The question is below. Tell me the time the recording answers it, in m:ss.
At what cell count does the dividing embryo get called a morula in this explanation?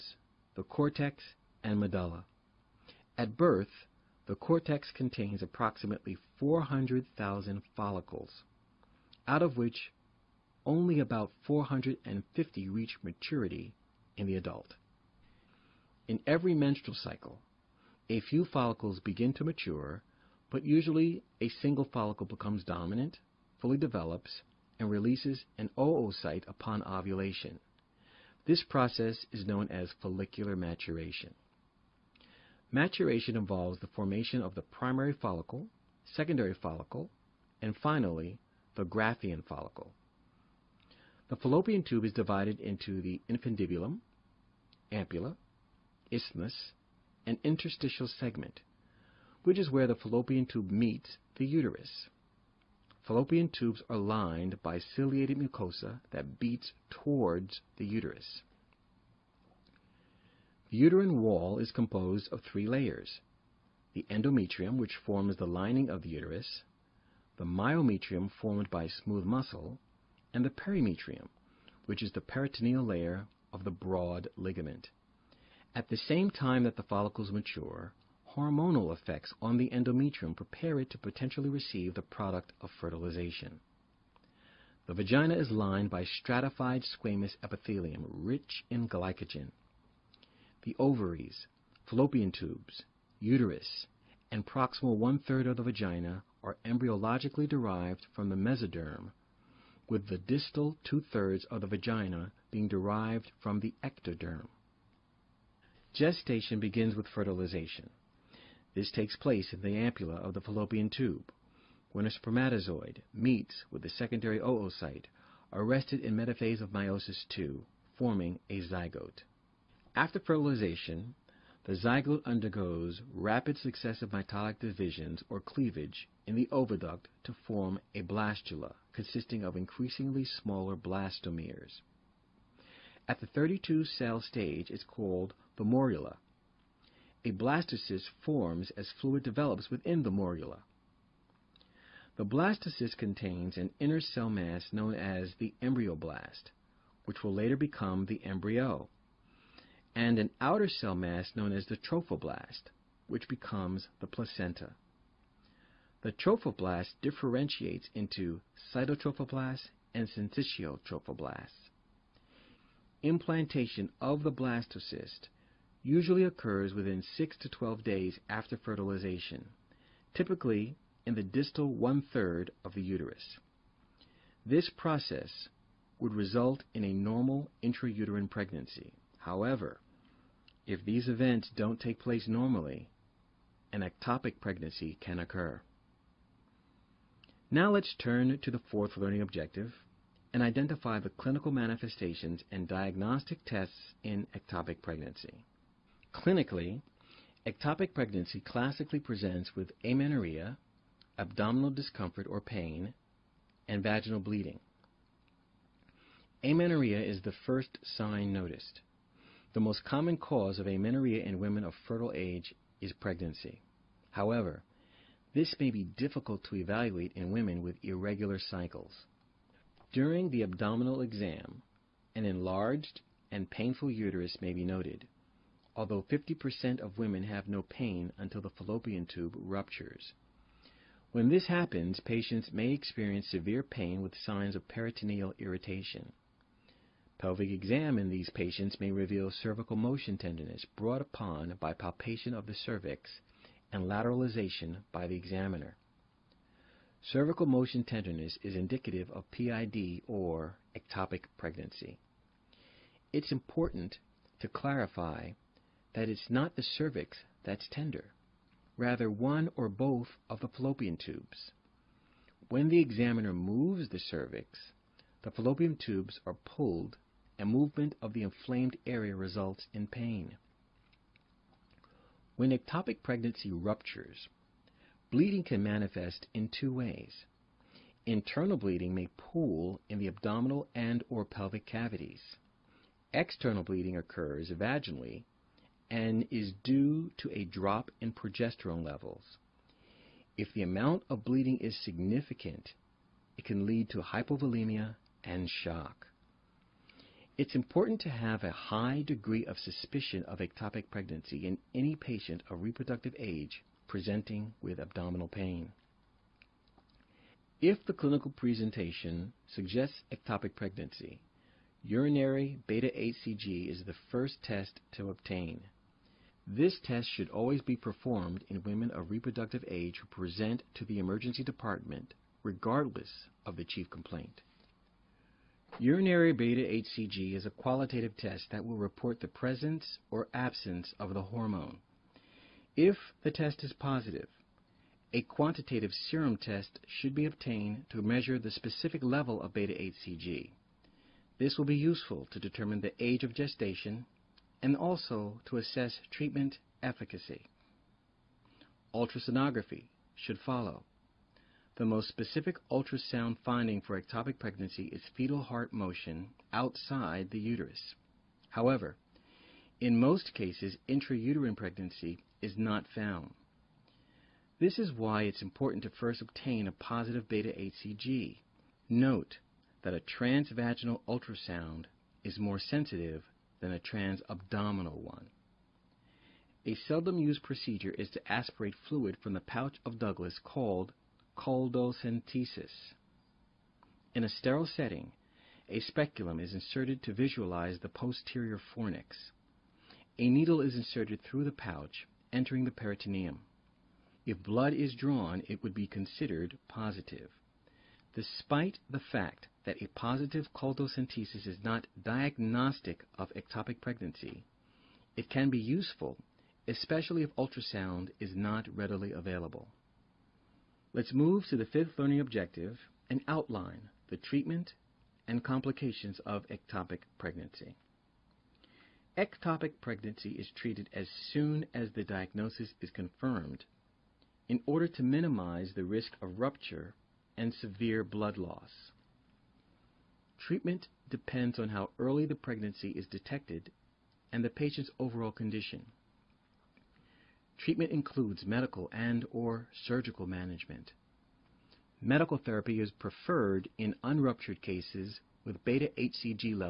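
2:13.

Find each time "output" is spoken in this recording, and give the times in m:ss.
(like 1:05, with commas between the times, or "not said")
not said.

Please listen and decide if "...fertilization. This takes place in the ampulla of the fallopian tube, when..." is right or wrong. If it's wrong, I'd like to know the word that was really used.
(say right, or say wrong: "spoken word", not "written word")
right.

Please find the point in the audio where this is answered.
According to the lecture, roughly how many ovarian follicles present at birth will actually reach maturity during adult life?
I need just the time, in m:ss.
0:11.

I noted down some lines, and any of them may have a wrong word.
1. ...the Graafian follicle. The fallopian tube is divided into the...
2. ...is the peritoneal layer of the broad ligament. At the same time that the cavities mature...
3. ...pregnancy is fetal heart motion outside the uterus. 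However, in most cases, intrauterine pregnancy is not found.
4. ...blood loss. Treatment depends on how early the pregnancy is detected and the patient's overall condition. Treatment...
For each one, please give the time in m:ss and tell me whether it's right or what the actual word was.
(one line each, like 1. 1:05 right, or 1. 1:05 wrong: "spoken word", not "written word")
1. 0:38 right
2. 1:12 wrong: "follicles", not "cavities"
3. 5:54 right
4. 7:08 right.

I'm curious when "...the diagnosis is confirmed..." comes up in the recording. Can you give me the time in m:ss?
7:01.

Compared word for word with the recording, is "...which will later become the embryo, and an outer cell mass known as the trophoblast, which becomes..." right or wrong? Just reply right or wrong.
right.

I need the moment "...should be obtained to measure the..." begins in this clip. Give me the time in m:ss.
5:36.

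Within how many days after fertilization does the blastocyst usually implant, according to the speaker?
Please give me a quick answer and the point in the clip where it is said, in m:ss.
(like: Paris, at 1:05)
6 to 12 days, at 2:47.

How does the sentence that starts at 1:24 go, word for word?
The vagina is lined by stratified squamous epithelium rich in glycogen.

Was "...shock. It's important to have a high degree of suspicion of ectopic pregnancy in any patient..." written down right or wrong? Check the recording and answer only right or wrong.
right.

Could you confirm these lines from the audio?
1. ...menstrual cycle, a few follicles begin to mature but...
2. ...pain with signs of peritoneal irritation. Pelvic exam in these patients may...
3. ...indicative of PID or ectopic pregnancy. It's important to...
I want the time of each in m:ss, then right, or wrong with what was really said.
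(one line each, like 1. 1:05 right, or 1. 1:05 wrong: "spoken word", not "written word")
1. 0:16 right
2. 3:53 right
3. 4:08 right.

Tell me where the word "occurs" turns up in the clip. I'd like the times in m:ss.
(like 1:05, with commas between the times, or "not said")
2:46, 3:05, 4:43.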